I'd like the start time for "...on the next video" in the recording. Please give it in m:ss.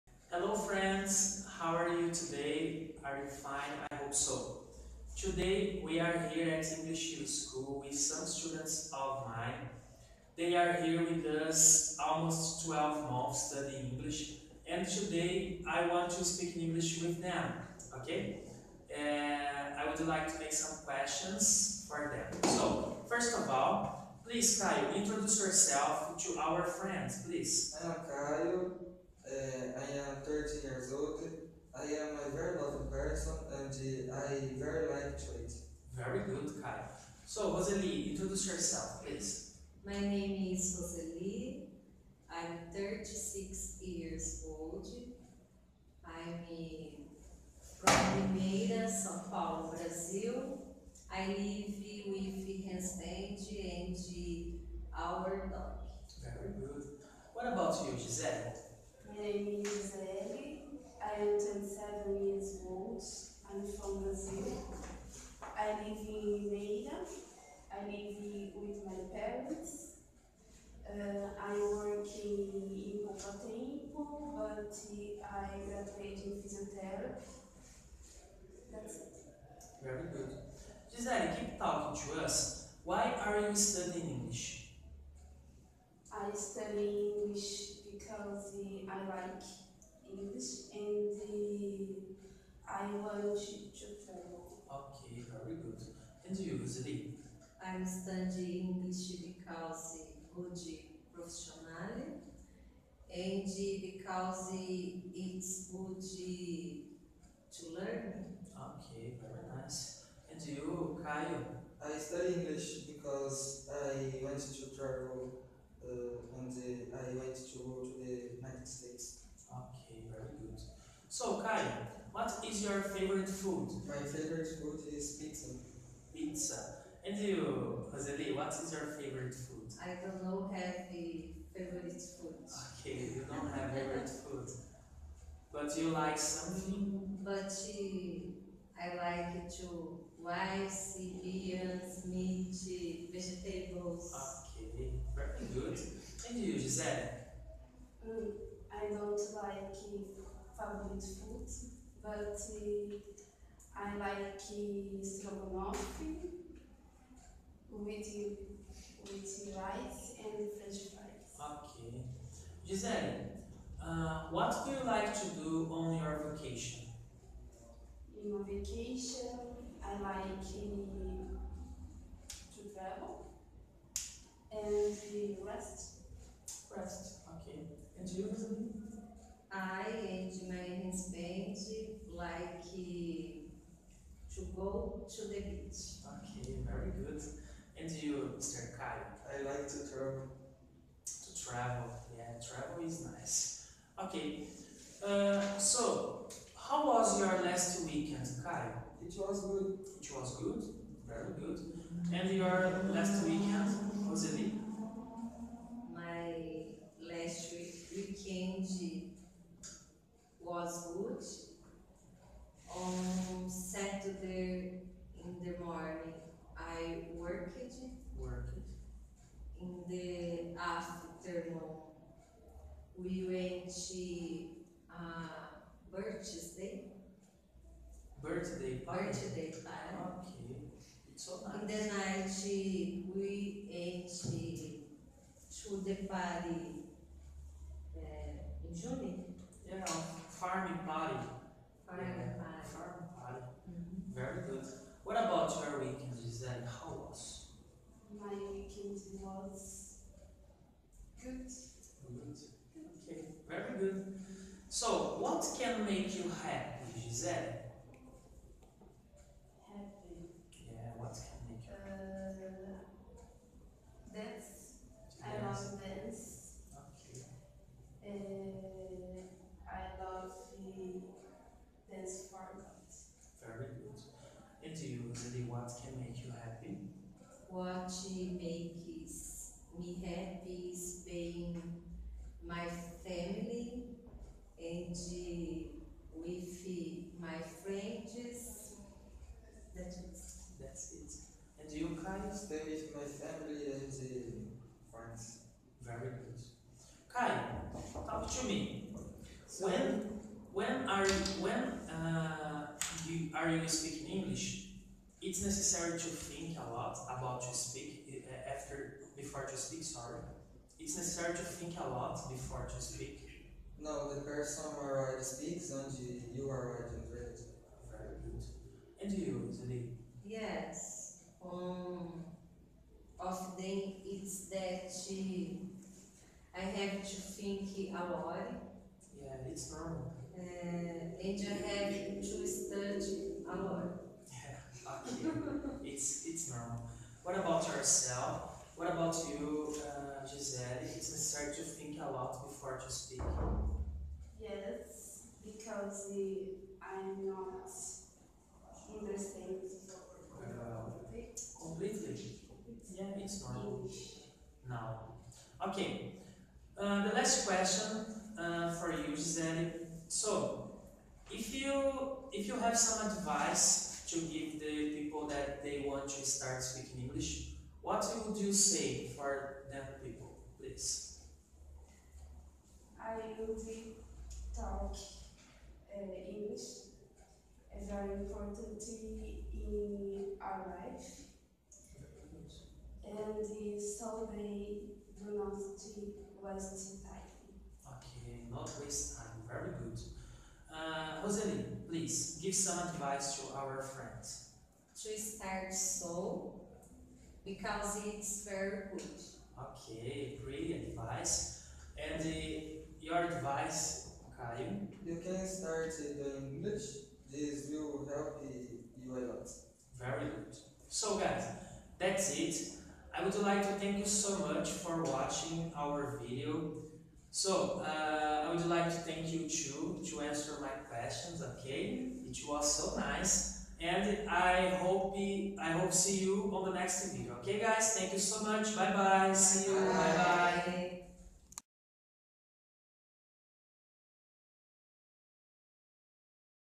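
7:06.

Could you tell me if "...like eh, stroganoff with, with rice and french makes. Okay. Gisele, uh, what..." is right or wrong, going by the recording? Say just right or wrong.
wrong.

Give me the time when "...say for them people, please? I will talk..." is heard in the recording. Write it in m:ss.
6:08.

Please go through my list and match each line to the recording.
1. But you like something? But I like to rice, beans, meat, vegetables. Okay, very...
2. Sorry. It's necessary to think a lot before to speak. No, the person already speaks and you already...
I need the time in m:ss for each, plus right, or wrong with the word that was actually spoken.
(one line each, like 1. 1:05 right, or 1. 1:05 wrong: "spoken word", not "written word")
1. 2:15 right
2. 5:09 right.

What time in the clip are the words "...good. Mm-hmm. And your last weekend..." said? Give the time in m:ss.
3:21.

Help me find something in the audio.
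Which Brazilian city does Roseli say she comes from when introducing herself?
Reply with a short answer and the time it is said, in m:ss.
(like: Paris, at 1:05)
Limeira, at 0:47.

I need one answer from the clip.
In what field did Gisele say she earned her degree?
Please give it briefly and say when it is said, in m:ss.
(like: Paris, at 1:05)
Physiotherapy, at 1:16.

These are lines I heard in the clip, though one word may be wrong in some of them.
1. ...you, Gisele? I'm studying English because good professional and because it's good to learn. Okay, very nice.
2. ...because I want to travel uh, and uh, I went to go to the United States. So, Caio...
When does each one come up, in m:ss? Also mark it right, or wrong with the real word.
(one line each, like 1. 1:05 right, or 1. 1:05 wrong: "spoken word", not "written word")
1. 1:36 wrong: "Zeli", not "Gisele"
2. 1:52 right.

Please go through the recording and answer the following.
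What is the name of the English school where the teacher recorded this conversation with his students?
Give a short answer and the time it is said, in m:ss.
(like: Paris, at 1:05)
English Hill School, at 0:06.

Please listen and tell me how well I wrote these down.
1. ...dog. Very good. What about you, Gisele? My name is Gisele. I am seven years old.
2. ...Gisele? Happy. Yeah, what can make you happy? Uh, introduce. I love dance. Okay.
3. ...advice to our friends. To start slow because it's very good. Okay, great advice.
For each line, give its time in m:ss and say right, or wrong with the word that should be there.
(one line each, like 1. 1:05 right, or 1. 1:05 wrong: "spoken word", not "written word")
1. 0:55 right
2. 4:17 wrong: "dance", not "introduce"
3. 6:32 right.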